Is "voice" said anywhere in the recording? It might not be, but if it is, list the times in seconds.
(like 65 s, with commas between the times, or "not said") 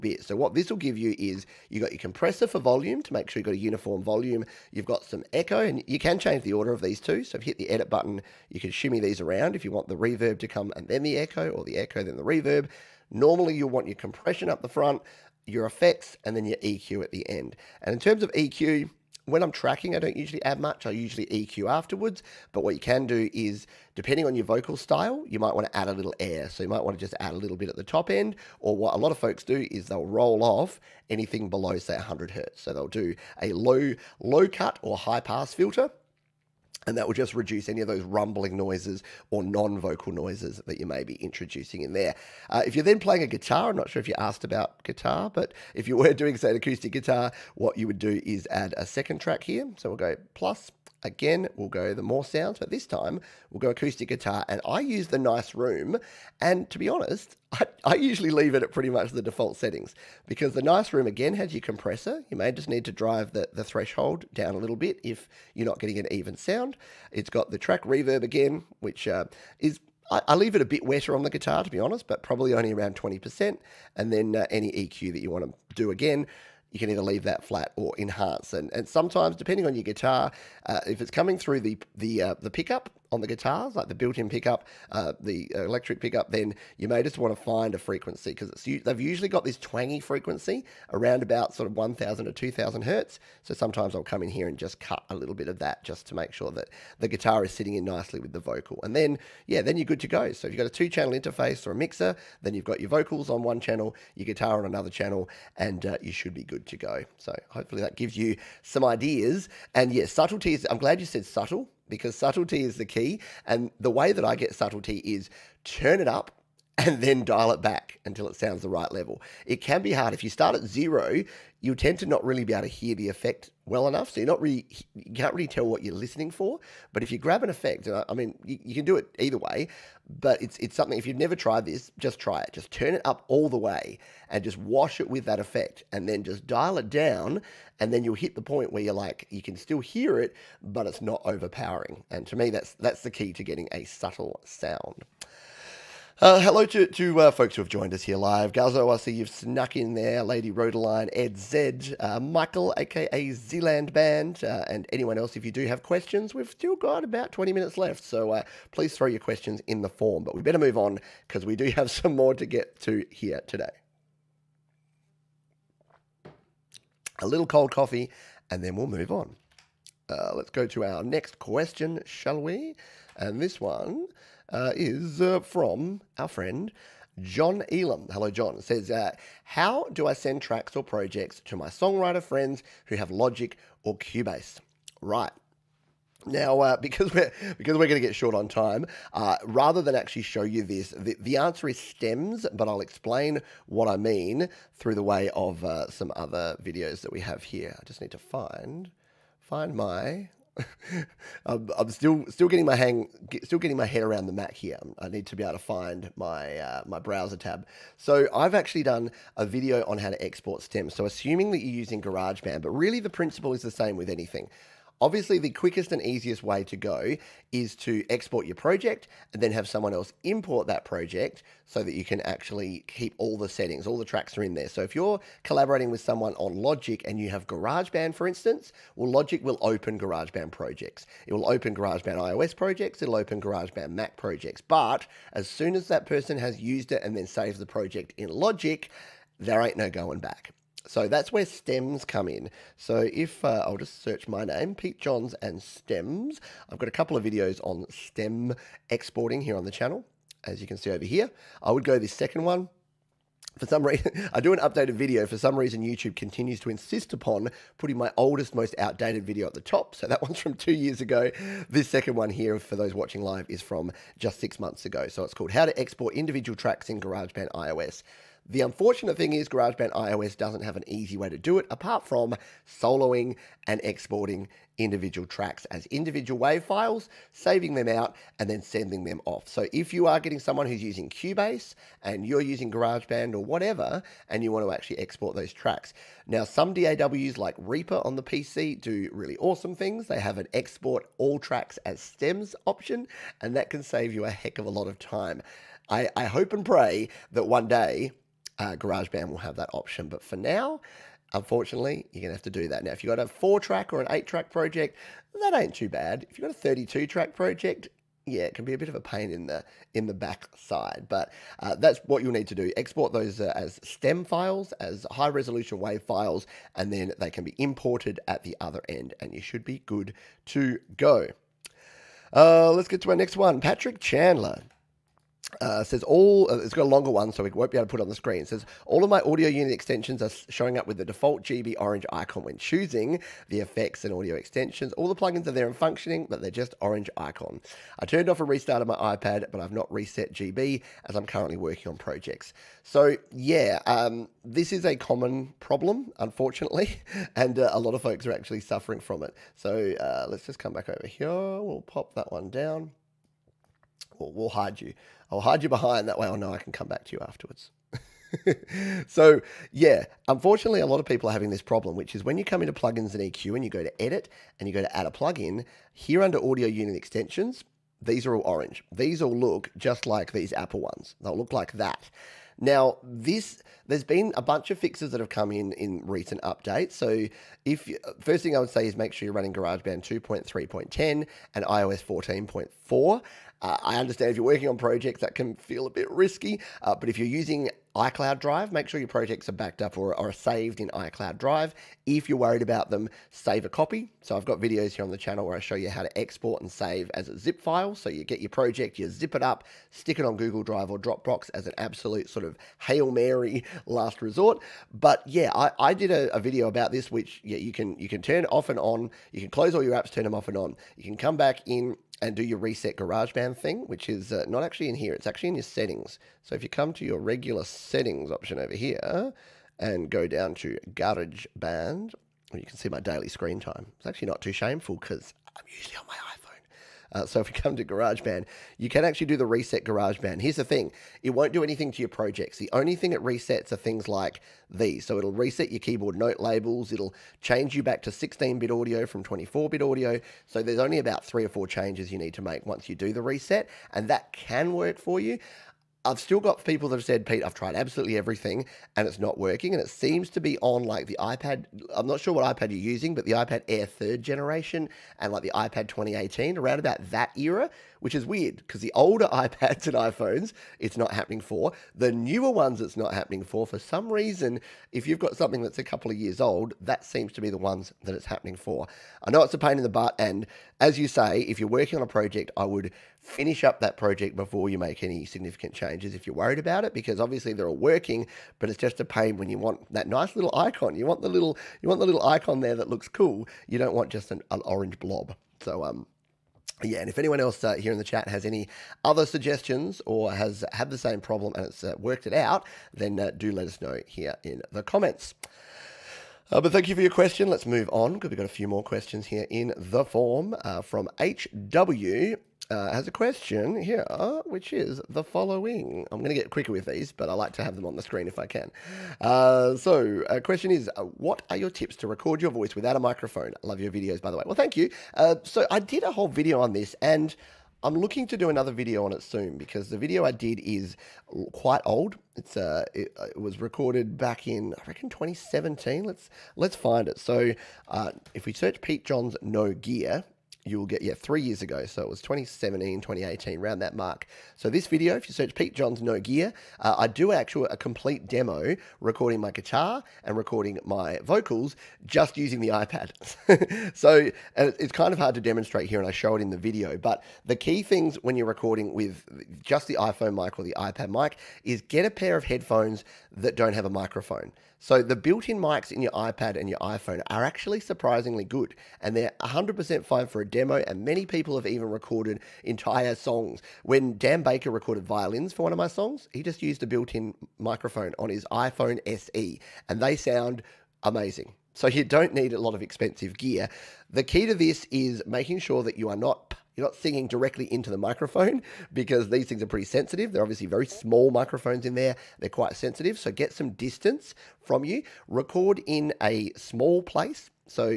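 512 s.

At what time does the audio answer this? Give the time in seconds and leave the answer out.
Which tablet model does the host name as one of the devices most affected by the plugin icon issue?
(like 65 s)
453 s.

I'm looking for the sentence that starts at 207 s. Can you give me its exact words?
So I've actually done a video on how to export stems.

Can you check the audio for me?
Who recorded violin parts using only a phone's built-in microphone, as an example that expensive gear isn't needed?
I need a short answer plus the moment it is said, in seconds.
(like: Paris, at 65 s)
Dan Baker, at 564 s.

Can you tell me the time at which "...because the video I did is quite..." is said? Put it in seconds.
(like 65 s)
519 s.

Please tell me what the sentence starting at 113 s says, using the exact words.
And the way that I get subtlety is turn it up and then dial it back until it sounds the right level.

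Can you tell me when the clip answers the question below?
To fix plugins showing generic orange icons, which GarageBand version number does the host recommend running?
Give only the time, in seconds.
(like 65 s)
380 s.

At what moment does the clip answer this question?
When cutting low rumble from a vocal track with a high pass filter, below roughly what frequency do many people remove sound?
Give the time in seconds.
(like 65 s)
31 s.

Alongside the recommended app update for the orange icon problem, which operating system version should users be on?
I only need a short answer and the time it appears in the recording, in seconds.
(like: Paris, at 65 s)
iOS 14.4, at 381 s.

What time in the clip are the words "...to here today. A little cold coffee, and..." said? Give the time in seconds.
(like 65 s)
162 s.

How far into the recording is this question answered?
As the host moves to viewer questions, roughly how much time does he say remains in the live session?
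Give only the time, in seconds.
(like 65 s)
157 s.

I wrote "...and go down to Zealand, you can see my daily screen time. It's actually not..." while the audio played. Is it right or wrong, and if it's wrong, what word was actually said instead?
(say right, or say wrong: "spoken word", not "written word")
wrong: "GarageBand", not "Zealand".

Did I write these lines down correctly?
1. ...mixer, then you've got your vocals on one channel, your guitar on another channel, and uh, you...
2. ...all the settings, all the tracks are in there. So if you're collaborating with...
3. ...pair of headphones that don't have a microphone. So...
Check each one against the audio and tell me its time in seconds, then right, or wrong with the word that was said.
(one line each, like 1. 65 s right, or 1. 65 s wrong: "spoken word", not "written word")
1. 101 s right
2. 223 s right
3. 552 s right.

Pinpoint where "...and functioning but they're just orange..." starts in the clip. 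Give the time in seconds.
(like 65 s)
335 s.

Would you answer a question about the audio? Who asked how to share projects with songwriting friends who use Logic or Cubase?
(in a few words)
John Elam.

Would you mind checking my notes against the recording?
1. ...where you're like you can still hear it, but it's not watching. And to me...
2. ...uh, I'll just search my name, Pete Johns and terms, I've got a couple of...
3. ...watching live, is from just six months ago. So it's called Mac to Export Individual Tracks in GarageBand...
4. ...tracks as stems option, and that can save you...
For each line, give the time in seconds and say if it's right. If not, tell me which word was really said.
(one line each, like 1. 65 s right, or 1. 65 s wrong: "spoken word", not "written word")
1. 138 s wrong: "overpowering", not "watching"
2. 243 s wrong: "stems", not "terms"
3. 262 s wrong: "How", not "Mac"
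4. 291 s right.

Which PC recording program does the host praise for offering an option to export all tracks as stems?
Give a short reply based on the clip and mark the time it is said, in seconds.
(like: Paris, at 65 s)
Reaper, at 287 s.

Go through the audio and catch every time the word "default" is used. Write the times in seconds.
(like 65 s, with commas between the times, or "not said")
59 s, 331 s.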